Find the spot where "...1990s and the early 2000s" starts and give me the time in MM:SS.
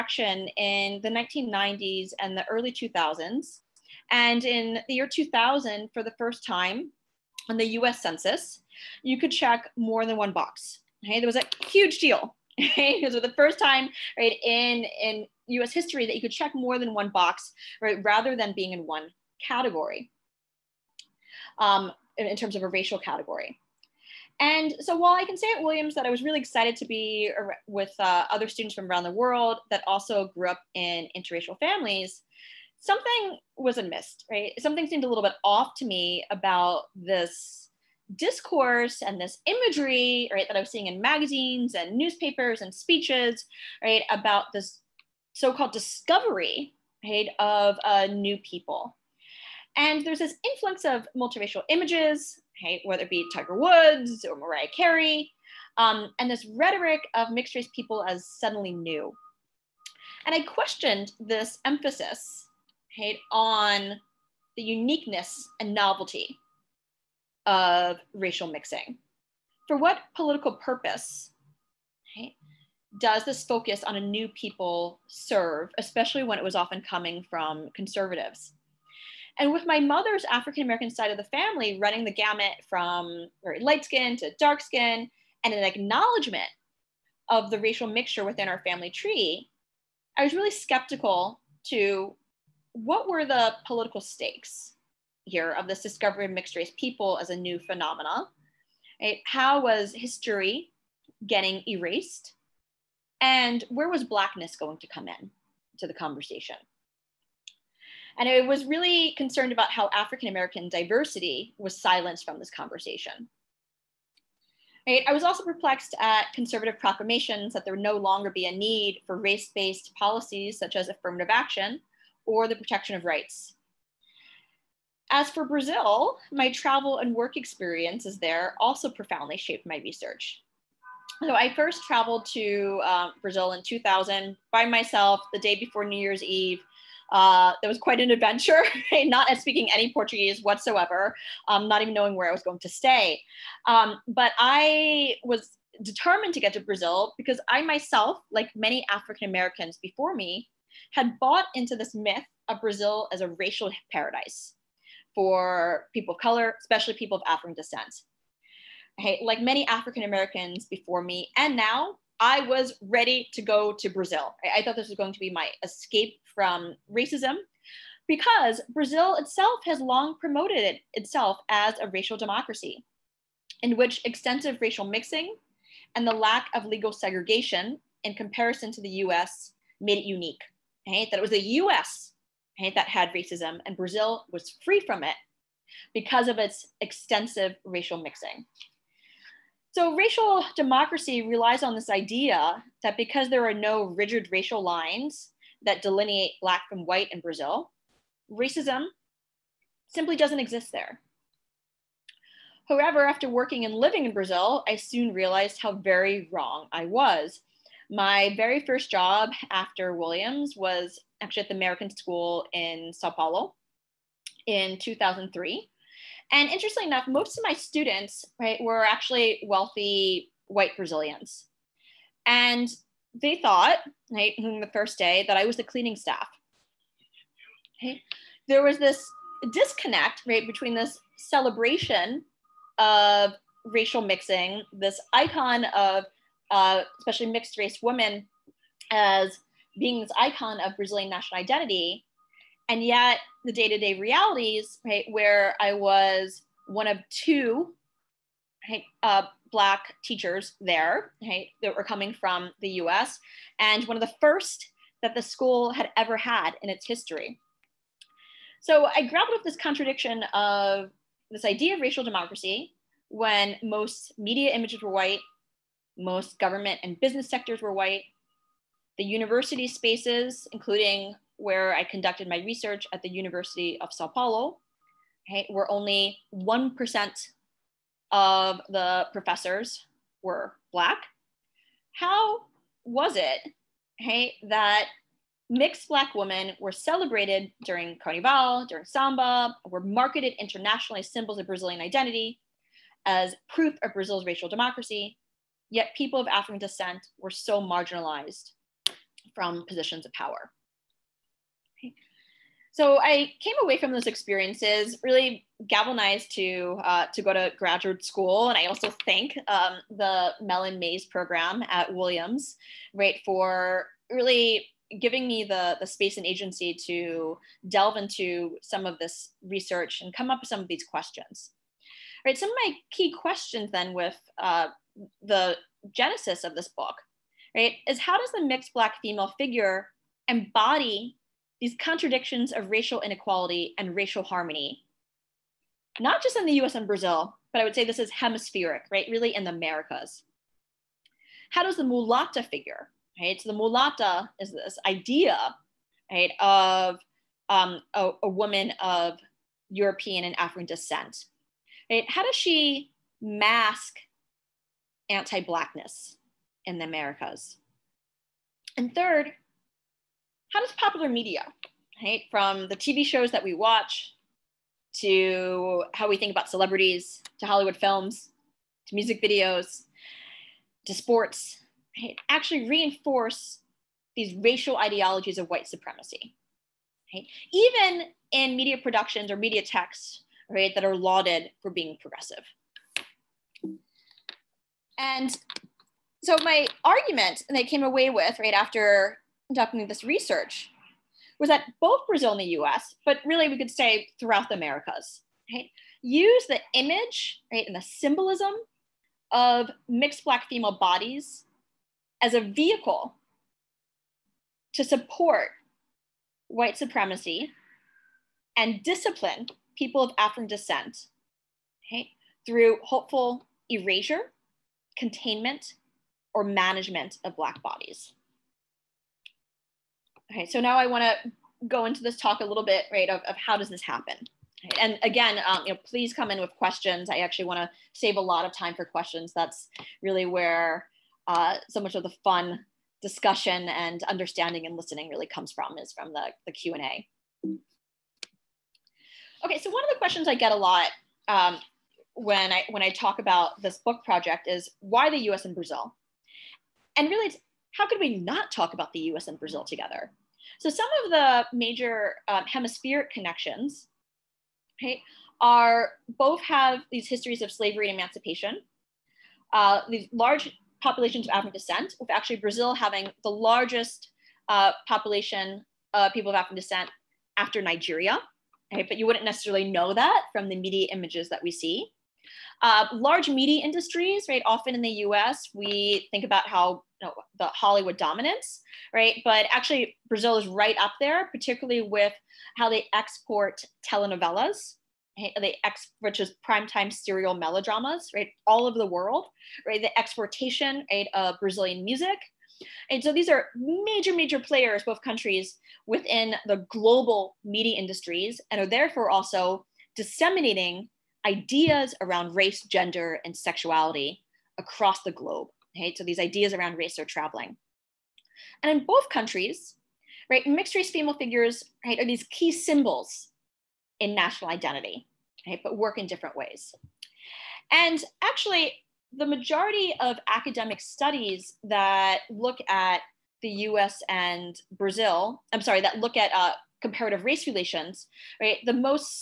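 00:01.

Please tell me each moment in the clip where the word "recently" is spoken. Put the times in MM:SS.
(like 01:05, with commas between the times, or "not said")
not said.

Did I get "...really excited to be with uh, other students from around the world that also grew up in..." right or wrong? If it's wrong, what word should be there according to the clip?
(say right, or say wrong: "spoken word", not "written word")
right.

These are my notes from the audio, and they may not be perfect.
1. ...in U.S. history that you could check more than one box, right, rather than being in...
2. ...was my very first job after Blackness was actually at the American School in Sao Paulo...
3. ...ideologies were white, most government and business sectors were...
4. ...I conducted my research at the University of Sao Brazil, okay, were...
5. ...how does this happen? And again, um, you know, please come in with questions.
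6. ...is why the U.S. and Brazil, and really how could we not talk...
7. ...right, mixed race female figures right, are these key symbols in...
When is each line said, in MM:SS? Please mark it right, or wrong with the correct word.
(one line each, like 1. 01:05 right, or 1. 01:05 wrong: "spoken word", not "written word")
1. 00:15 right
2. 03:26 wrong: "Williams", not "Blackness"
3. 04:24 wrong: "images", not "ideologies"
4. 04:31 wrong: "Paulo", not "Brazil"
5. 07:03 right
6. 07:24 right
7. 08:30 right.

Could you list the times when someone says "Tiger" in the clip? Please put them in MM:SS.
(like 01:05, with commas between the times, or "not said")
00:53.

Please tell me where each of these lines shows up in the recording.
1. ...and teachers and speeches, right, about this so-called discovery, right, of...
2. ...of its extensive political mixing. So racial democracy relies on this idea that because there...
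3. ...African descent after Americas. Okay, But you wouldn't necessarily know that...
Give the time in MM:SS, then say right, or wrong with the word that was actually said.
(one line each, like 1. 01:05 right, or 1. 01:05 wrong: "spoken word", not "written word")
1. 00:41 wrong: "newspapers", not "teachers"
2. 03:06 wrong: "racial", not "political"
3. 07:46 wrong: "Nigeria", not "Americas".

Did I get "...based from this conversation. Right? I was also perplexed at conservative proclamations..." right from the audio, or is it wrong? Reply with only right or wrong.
wrong.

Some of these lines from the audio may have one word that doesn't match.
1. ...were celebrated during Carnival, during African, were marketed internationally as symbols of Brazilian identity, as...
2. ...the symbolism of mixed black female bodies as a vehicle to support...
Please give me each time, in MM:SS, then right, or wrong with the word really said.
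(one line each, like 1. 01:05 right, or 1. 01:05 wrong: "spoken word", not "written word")
1. 04:46 wrong: "Samba", not "African"
2. 06:37 right.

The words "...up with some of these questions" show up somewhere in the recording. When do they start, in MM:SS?
05:20.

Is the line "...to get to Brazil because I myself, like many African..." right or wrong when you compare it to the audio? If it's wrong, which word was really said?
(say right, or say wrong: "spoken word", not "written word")
right.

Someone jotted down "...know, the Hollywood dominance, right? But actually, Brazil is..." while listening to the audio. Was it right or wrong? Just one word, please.
right.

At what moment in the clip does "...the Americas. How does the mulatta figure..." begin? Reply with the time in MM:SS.
05:39.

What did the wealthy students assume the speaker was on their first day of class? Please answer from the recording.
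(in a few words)
the cleaning staff.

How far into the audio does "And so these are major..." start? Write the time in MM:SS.
08:12.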